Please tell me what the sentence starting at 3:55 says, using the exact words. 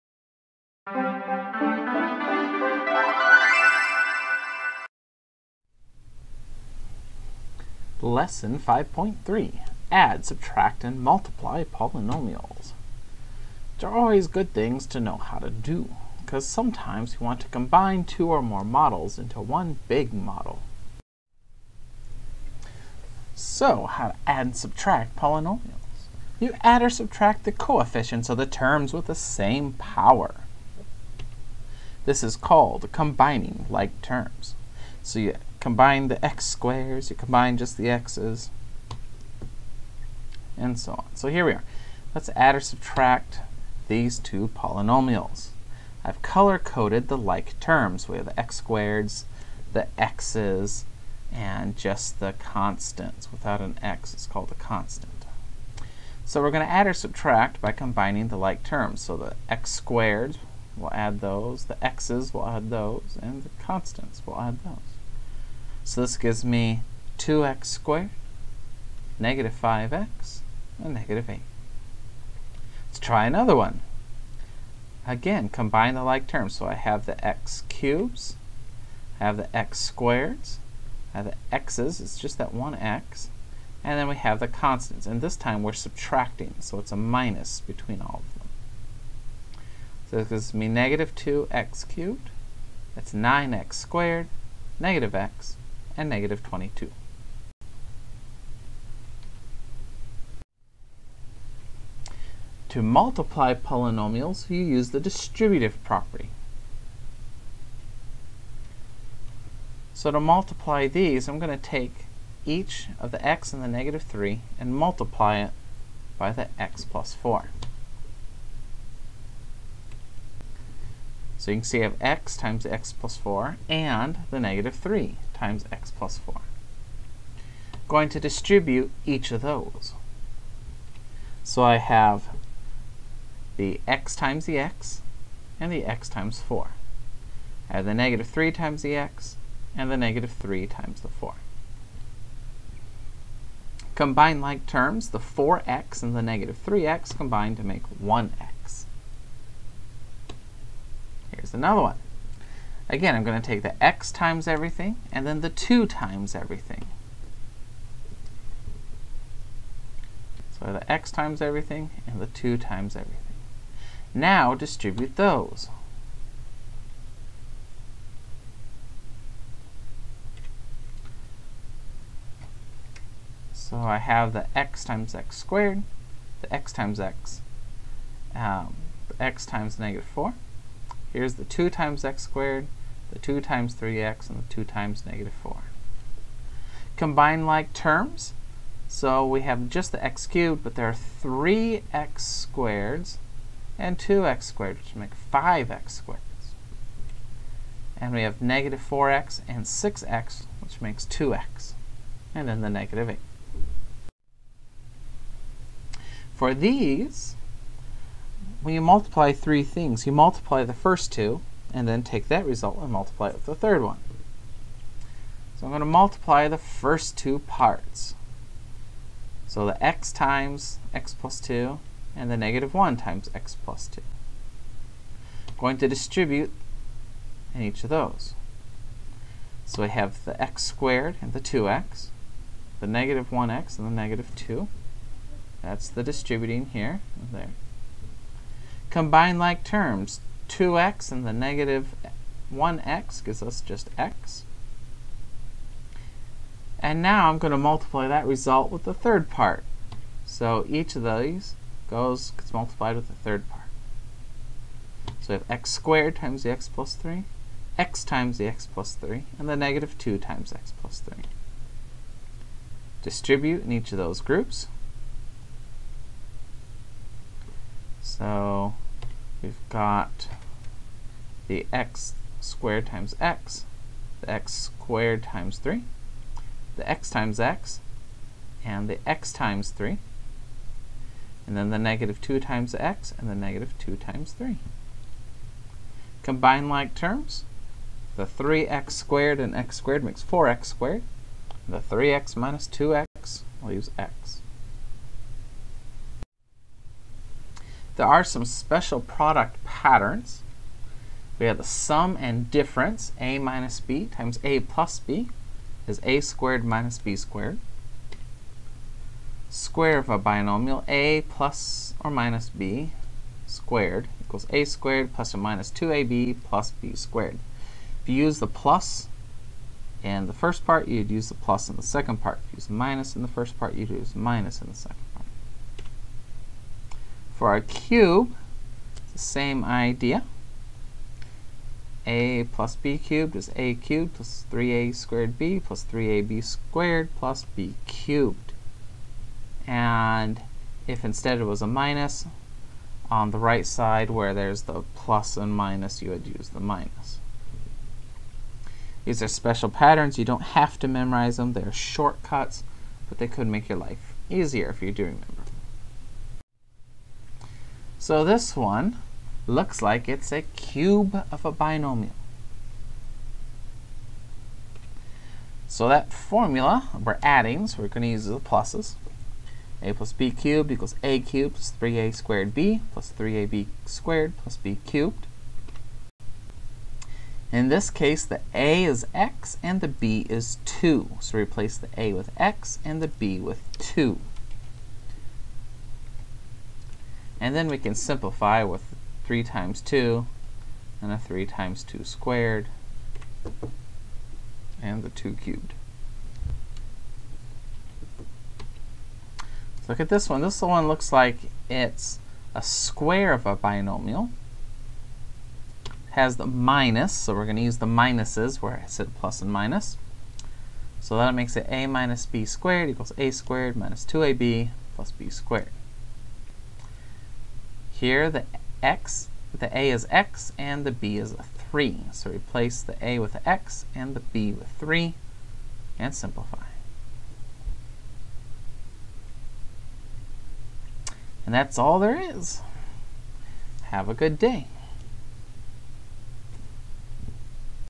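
That's the distributing here and there.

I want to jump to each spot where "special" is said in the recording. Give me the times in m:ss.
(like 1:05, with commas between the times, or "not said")
4:58, 5:49.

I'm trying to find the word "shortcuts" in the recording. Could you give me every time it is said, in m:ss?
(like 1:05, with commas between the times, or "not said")
5:51.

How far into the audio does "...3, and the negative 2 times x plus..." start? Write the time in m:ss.
4:18.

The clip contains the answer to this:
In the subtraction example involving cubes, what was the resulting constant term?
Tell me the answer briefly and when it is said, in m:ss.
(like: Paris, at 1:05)
-22, at 1:36.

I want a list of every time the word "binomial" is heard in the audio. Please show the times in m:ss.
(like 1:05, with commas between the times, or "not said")
5:10, 6:01, 6:43.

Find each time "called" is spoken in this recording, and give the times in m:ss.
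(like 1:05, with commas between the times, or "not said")
0:32, 0:54.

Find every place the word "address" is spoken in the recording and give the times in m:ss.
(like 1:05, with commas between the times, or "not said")
not said.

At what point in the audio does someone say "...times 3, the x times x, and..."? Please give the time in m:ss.
4:35.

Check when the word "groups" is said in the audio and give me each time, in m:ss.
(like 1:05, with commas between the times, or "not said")
4:24.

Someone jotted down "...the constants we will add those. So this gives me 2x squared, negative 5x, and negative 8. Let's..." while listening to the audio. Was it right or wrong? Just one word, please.
right.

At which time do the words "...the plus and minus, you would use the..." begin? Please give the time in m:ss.
5:44.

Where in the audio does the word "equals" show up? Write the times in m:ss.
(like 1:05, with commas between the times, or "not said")
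5:14, 6:10, 6:52.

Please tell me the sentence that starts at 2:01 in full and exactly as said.
So you can see I have x times x plus 4 and the negative 3 times x plus 4.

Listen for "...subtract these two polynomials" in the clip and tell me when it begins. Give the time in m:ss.
0:42.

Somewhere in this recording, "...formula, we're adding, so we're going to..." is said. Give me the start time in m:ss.
6:06.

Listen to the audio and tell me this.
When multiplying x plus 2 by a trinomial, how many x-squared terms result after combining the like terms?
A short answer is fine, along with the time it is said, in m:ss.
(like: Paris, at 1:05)
5, at 3:15.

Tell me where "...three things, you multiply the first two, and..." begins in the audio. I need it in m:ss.
3:29.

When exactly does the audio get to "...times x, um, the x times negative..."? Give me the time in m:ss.
2:56.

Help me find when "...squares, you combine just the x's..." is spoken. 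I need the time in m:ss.
0:36.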